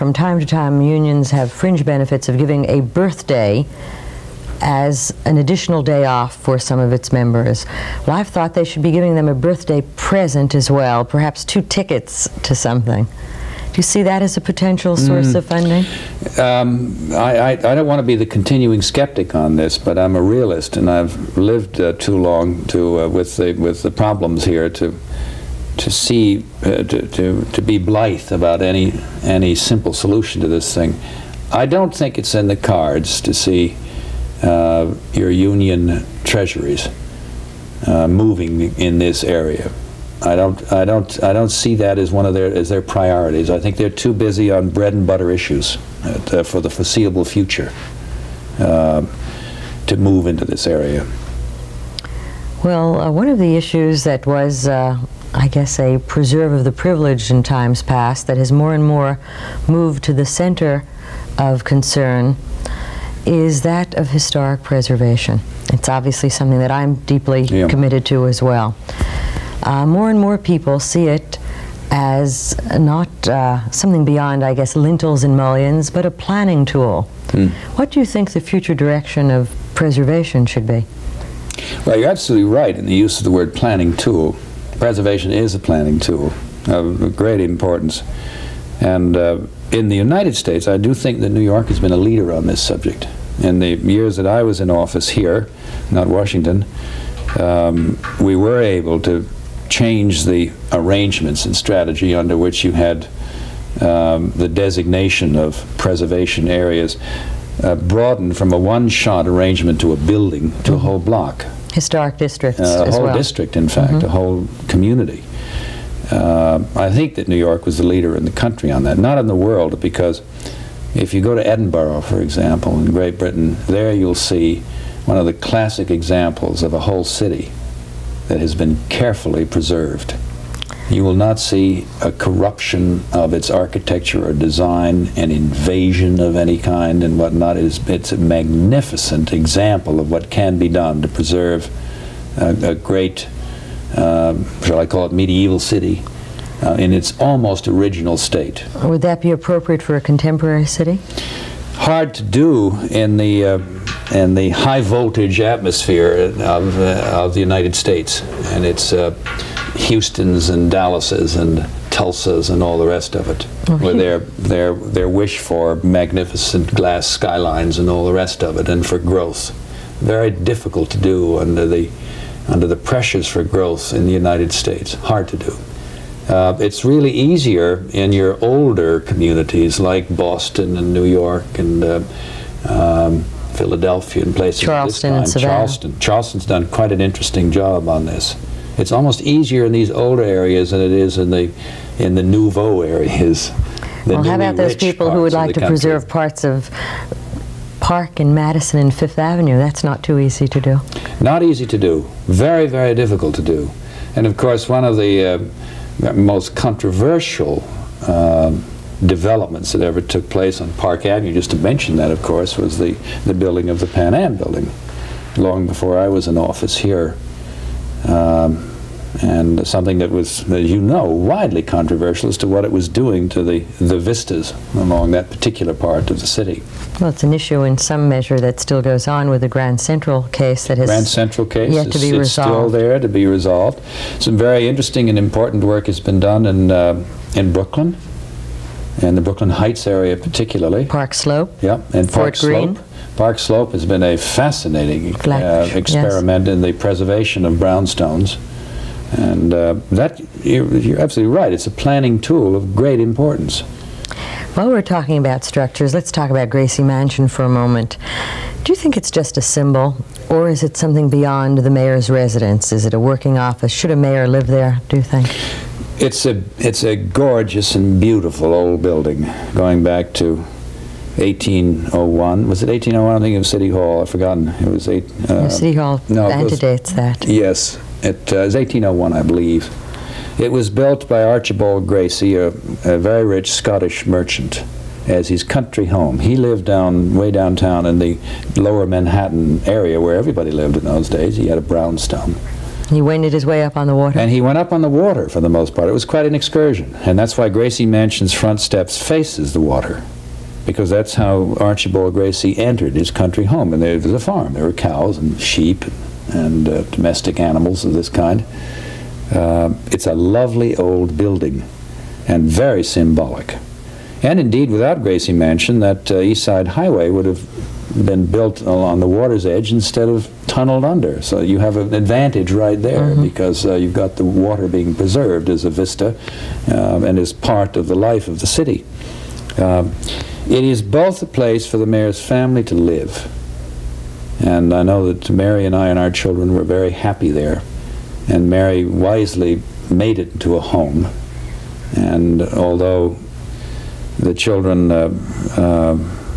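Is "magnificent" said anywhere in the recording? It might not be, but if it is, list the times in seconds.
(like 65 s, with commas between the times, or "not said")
138 s, 165 s.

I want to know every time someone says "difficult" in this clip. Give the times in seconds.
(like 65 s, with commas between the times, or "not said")
170 s, 202 s.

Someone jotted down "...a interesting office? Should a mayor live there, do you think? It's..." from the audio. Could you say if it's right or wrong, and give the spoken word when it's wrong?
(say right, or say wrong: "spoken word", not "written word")
wrong: "working", not "interesting".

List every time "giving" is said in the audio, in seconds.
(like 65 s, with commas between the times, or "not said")
2 s, 8 s.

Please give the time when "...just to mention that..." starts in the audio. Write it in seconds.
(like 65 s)
211 s.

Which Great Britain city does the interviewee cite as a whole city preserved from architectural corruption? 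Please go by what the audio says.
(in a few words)
Edinburgh.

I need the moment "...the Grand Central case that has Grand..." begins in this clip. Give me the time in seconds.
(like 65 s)
229 s.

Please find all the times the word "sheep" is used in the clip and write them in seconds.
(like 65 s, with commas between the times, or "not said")
305 s.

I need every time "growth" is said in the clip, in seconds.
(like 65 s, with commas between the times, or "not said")
168 s, 173 s.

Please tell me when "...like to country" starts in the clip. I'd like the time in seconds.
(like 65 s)
195 s.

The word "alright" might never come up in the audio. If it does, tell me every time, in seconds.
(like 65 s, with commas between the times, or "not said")
not said.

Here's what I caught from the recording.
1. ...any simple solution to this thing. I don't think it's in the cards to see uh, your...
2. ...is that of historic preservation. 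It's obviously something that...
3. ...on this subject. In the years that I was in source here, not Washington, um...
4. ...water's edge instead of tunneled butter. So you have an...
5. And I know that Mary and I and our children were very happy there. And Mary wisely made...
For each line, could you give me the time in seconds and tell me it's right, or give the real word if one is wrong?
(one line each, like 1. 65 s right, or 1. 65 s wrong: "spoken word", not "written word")
1. 29 s right
2. 63 s right
3. 92 s wrong: "office", not "source"
4. 319 s wrong: "under", not "butter"
5. 334 s right.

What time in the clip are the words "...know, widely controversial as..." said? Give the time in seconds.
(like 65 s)
220 s.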